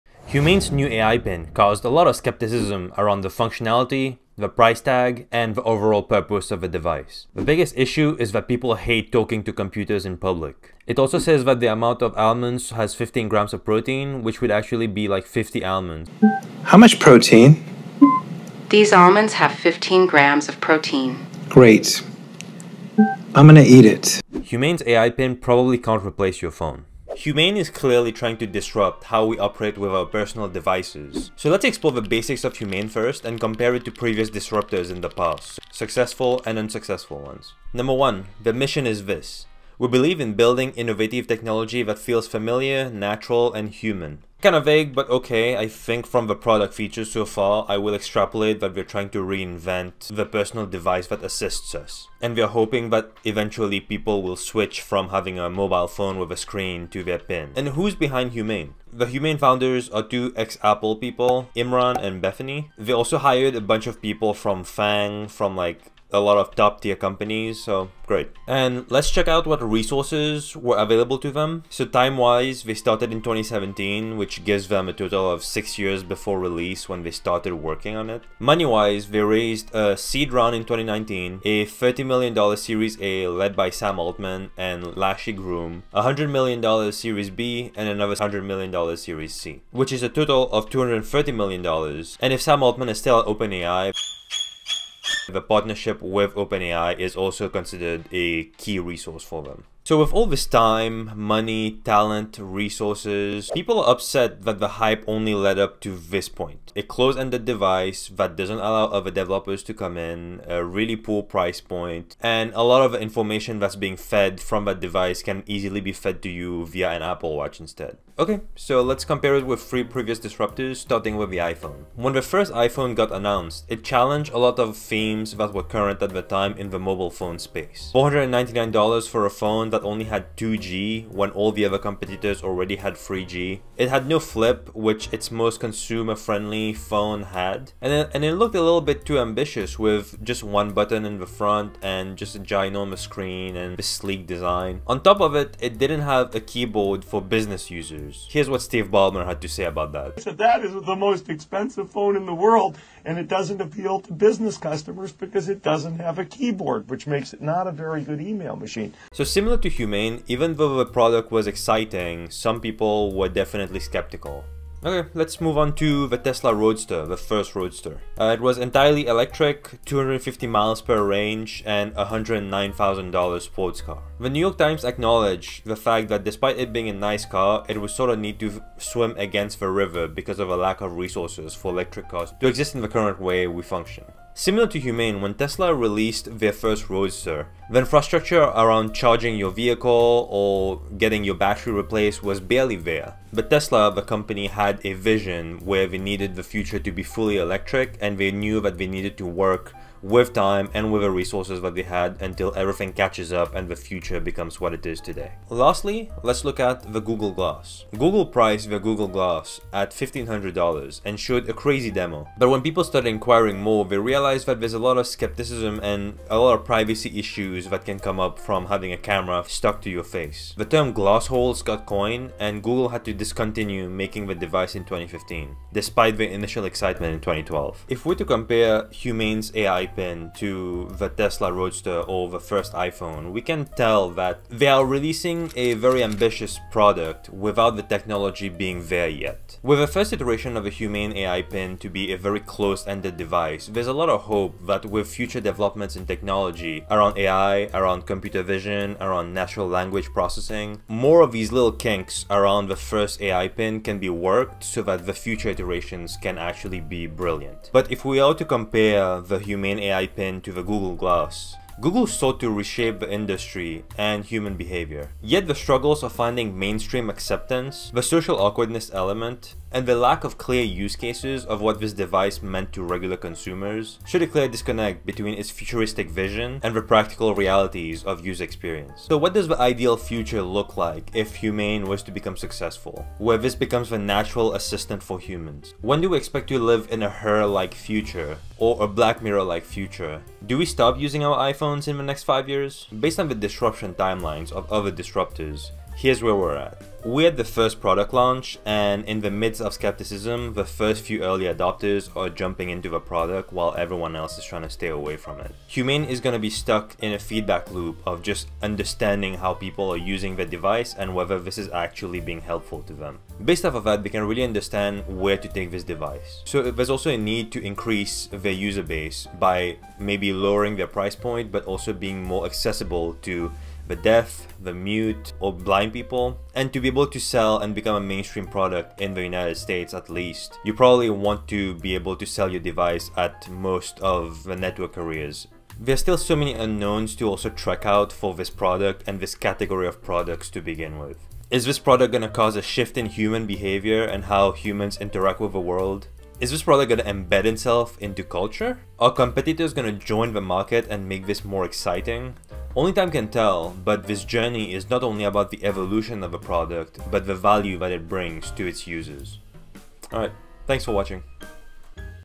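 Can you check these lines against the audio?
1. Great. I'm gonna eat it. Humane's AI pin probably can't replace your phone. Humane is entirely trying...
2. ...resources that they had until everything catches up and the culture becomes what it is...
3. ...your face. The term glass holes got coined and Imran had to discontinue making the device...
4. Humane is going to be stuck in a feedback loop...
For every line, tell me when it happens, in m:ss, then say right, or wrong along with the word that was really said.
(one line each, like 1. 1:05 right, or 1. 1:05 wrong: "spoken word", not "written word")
1. 0:21 wrong: "clearly", not "entirely"
2. 3:21 wrong: "future", not "culture"
3. 3:39 wrong: "Google", not "Imran"
4. 5:05 right.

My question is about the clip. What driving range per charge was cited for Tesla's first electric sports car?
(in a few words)
250 miles.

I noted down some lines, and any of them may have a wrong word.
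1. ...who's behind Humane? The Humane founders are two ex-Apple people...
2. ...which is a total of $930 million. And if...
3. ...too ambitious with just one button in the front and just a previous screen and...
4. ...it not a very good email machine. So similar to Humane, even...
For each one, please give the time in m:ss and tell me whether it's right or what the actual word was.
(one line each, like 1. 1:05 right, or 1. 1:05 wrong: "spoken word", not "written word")
1. 0:57 right
2. 1:29 wrong: "230", not "930"
3. 2:19 wrong: "ginormous", not "previous"
4. 2:37 right.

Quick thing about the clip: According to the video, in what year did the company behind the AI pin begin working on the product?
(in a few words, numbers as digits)
2017.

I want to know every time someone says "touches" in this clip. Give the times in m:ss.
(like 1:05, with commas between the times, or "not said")
not said.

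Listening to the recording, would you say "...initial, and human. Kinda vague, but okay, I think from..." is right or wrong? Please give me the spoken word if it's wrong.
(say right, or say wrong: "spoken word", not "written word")
wrong: "natural", not "initial".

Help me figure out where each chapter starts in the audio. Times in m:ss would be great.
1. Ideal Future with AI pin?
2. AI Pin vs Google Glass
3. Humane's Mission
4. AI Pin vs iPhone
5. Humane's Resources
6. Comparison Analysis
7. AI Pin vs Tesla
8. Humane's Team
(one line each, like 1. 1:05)
1. 4:40
2. 3:25
3. 0:30
4. 2:00
5. 1:09
6. 3:48
7. 2:46
8. 0:58.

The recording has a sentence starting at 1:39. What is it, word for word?
So with all this time, money, talent, resources, people are upset that the hype only led up to this point.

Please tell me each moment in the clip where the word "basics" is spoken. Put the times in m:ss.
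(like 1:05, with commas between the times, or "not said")
0:32.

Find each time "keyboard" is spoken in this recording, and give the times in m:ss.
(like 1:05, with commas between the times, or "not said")
2:26, 2:36.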